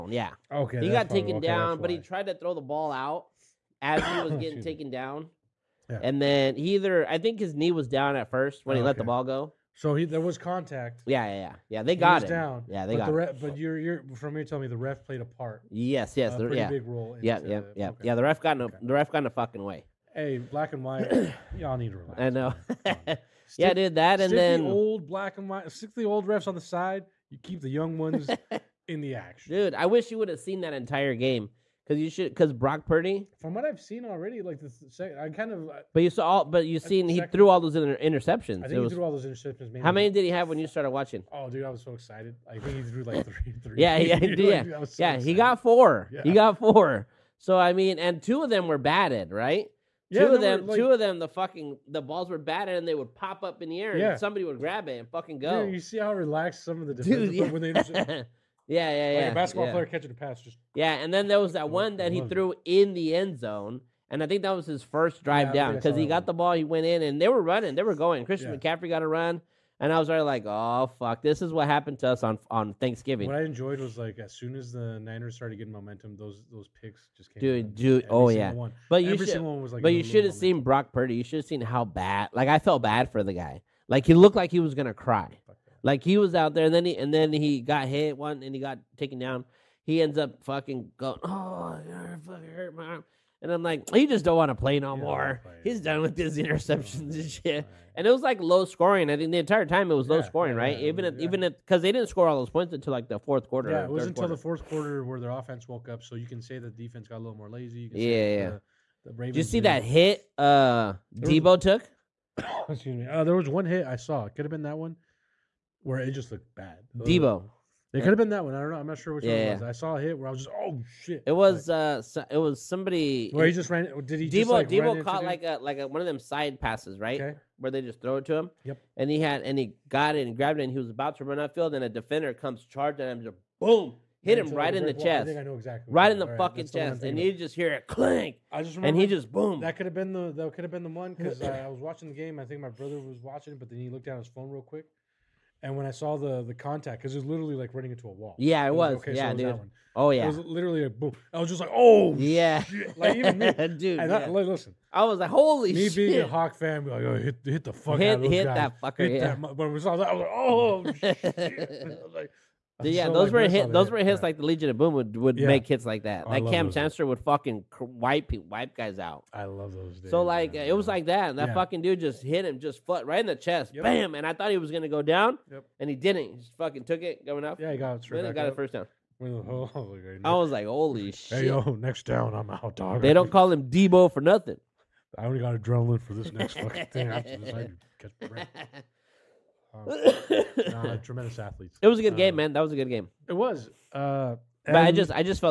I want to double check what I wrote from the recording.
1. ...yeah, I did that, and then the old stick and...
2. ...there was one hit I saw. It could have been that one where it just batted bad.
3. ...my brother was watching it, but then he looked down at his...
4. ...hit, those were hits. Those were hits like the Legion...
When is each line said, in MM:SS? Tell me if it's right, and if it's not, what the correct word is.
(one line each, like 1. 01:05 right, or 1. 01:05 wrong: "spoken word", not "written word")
1. 00:23 wrong: "black", not "stick"
2. 01:53 wrong: "looked", not "batted"
3. 02:22 right
4. 02:43 right.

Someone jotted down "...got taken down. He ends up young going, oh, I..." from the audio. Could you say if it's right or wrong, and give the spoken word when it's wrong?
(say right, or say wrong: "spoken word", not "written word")
wrong: "fucking", not "young".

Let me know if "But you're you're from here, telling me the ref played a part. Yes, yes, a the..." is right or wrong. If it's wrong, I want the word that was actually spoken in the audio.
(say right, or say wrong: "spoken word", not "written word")
right.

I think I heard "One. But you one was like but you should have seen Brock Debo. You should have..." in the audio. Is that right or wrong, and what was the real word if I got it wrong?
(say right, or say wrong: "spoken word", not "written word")
wrong: "Purdy", not "Debo".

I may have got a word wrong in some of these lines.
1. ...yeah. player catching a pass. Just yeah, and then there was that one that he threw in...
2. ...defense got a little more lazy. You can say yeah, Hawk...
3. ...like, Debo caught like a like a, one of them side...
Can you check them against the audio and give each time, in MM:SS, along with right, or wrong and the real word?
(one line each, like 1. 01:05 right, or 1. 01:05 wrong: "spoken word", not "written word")
1. 00:59 right
2. 01:46 wrong: "The", not "Hawk"
3. 02:04 right.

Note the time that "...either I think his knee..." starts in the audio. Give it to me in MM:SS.
00:06.